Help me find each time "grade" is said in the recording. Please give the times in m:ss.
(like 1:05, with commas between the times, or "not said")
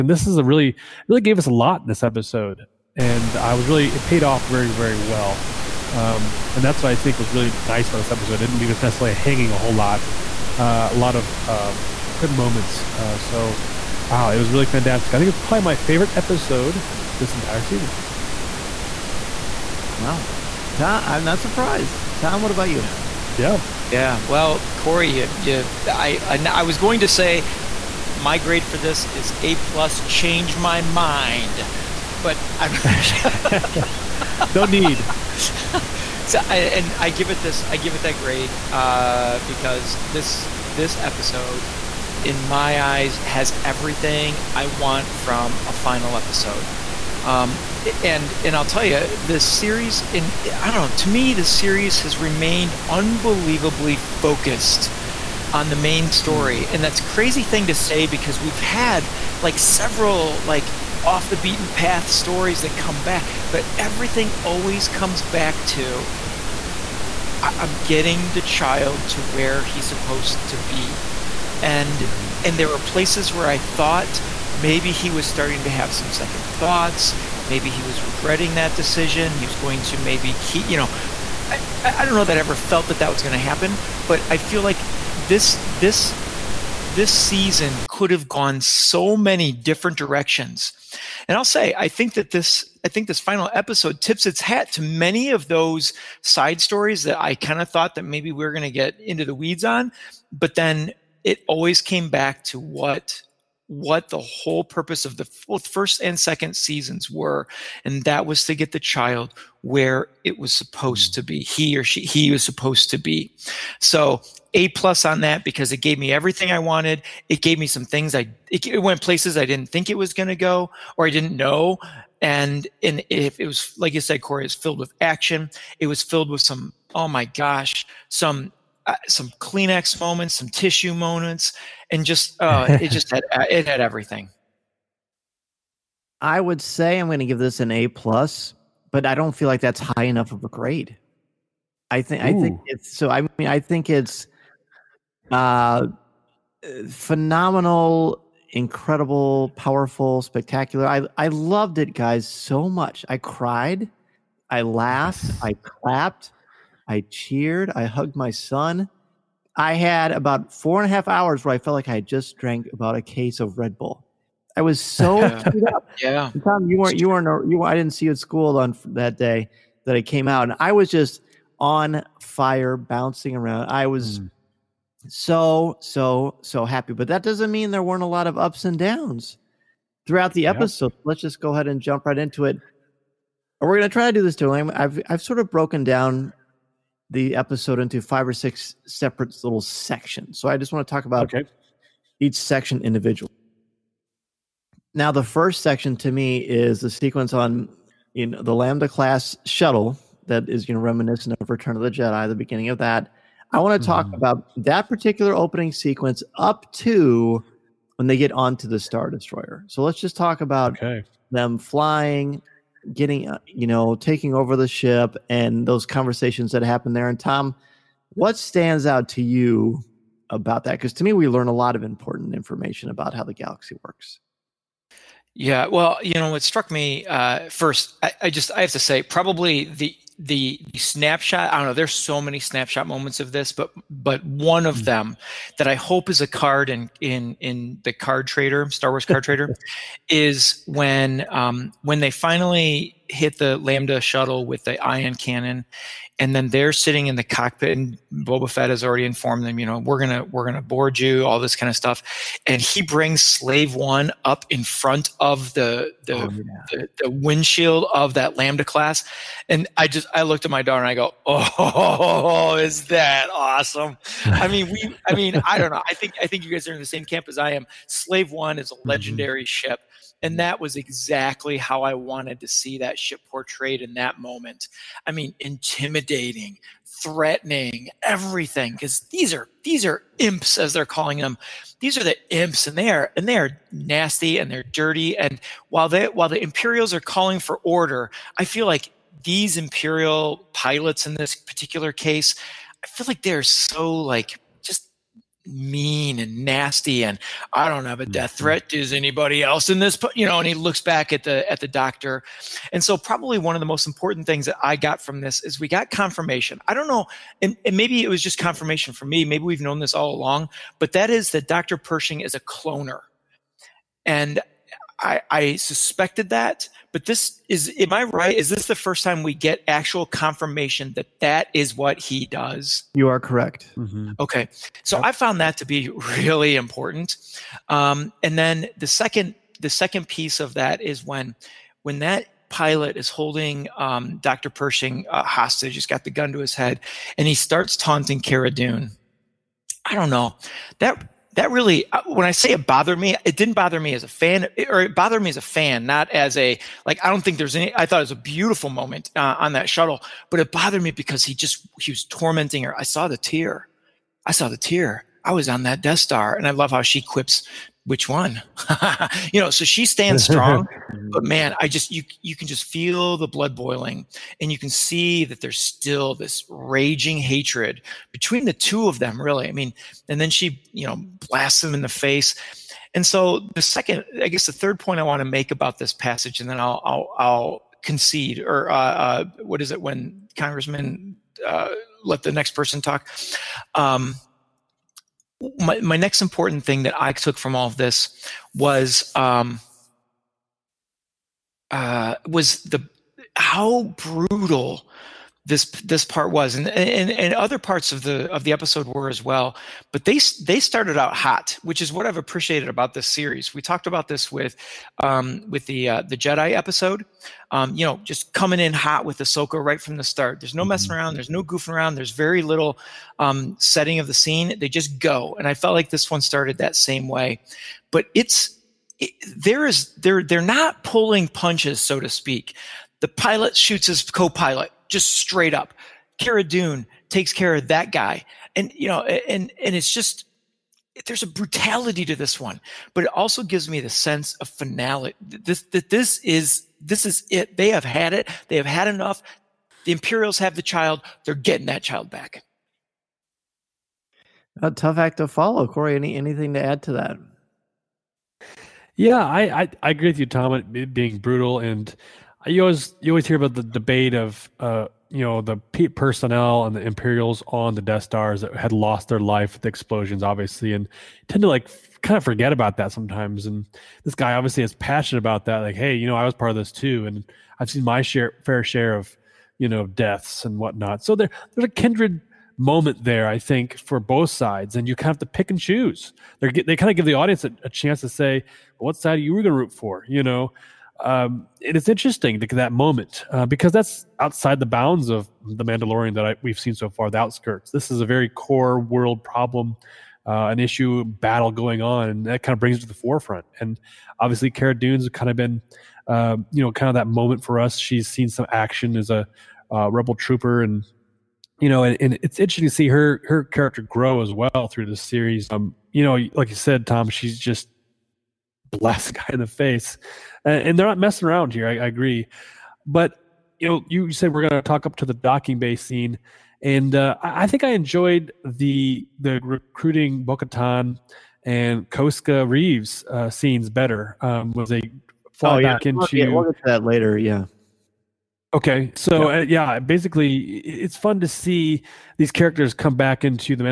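0:28, 0:38, 2:20.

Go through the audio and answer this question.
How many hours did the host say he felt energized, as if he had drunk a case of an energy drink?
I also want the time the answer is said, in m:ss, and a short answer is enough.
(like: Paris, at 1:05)
4.5, at 2:40.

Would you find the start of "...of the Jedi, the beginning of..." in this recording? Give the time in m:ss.
3:21.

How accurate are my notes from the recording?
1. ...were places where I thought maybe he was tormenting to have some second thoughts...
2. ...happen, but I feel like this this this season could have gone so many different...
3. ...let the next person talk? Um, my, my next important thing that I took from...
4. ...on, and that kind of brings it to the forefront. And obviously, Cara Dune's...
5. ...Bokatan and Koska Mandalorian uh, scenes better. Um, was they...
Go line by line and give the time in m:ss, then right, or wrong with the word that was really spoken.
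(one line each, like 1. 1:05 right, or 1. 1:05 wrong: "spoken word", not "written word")
1. 1:12 wrong: "starting", not "tormenting"
2. 1:23 right
3. 6:22 right
4. 8:11 right
5. 8:40 wrong: "Reeves", not "Mandalorian".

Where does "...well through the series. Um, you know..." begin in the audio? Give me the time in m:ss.
8:24.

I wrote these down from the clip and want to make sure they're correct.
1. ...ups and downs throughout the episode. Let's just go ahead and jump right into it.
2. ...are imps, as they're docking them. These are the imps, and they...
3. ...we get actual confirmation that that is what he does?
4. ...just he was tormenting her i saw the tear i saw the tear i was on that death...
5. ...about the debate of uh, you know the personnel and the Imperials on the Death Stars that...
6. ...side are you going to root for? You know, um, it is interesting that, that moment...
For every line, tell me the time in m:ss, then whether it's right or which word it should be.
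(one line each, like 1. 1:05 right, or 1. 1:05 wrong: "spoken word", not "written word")
1. 2:58 right
2. 4:39 wrong: "calling", not "docking"
3. 5:19 right
4. 5:51 right
5. 7:33 right
6. 7:58 right.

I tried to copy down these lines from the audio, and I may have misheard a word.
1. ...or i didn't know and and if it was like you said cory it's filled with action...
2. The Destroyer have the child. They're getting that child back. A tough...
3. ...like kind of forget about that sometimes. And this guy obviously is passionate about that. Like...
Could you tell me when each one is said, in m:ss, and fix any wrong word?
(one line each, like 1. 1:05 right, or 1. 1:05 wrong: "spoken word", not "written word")
1. 2:00 right
2. 7:19 wrong: "Imperials", not "Destroyer"
3. 7:41 right.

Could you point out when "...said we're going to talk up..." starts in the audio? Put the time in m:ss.
8:34.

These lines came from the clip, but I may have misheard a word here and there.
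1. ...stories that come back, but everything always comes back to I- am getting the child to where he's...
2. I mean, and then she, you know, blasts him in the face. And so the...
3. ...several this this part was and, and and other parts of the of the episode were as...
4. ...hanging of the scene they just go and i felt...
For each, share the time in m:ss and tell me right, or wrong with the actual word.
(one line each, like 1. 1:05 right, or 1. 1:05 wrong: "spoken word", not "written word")
1. 1:02 right
2. 6:09 right
3. 6:33 wrong: "brutal", not "several"
4. 6:53 wrong: "setting", not "hanging".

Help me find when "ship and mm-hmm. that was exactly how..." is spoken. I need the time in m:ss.
4:29.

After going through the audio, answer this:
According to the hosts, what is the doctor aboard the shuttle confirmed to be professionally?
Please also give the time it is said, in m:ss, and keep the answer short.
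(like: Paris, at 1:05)
a cloner, at 5:12.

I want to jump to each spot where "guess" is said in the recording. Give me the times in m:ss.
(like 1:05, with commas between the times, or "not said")
6:14.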